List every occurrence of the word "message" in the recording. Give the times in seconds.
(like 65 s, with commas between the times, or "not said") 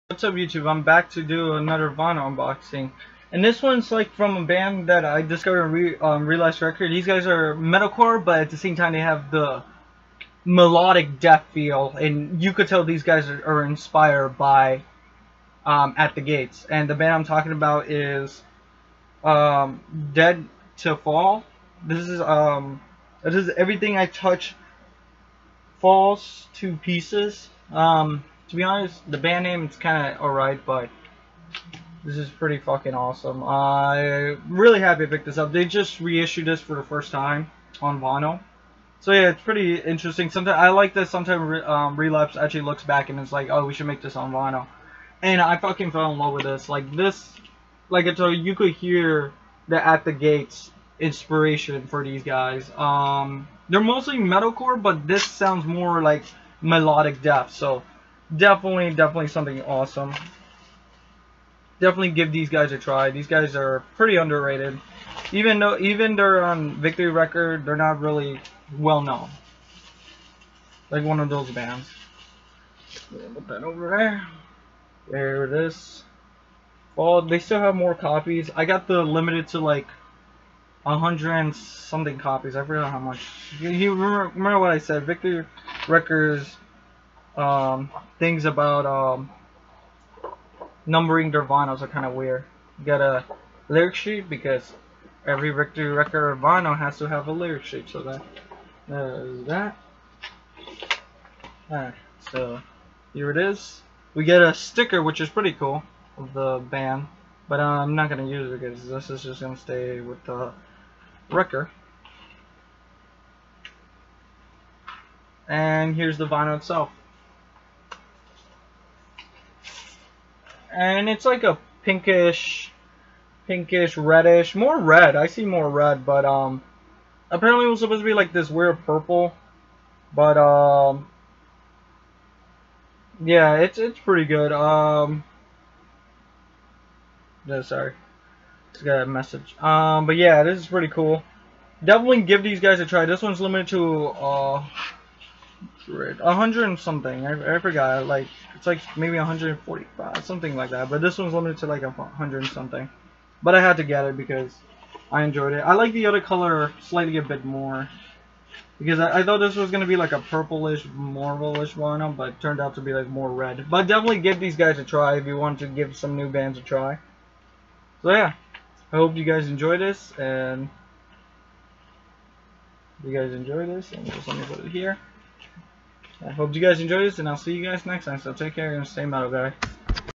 139 s.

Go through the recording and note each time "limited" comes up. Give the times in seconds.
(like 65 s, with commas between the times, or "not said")
79 s, 143 s, 151 s.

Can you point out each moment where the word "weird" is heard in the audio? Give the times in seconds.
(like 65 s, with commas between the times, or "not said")
92 s, 128 s.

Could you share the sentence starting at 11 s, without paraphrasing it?
And you could tell these guys are, are inspired by um, At The Gates.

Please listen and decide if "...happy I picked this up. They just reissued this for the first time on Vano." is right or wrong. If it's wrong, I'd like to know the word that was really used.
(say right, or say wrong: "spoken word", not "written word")
right.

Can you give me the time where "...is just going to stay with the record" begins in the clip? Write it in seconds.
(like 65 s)
109 s.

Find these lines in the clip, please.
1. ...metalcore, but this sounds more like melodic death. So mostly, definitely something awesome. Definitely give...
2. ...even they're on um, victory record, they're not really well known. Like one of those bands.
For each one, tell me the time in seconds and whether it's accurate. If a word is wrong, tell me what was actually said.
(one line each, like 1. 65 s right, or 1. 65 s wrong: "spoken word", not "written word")
1. 54 s wrong: "definitely", not "mostly"
2. 65 s right.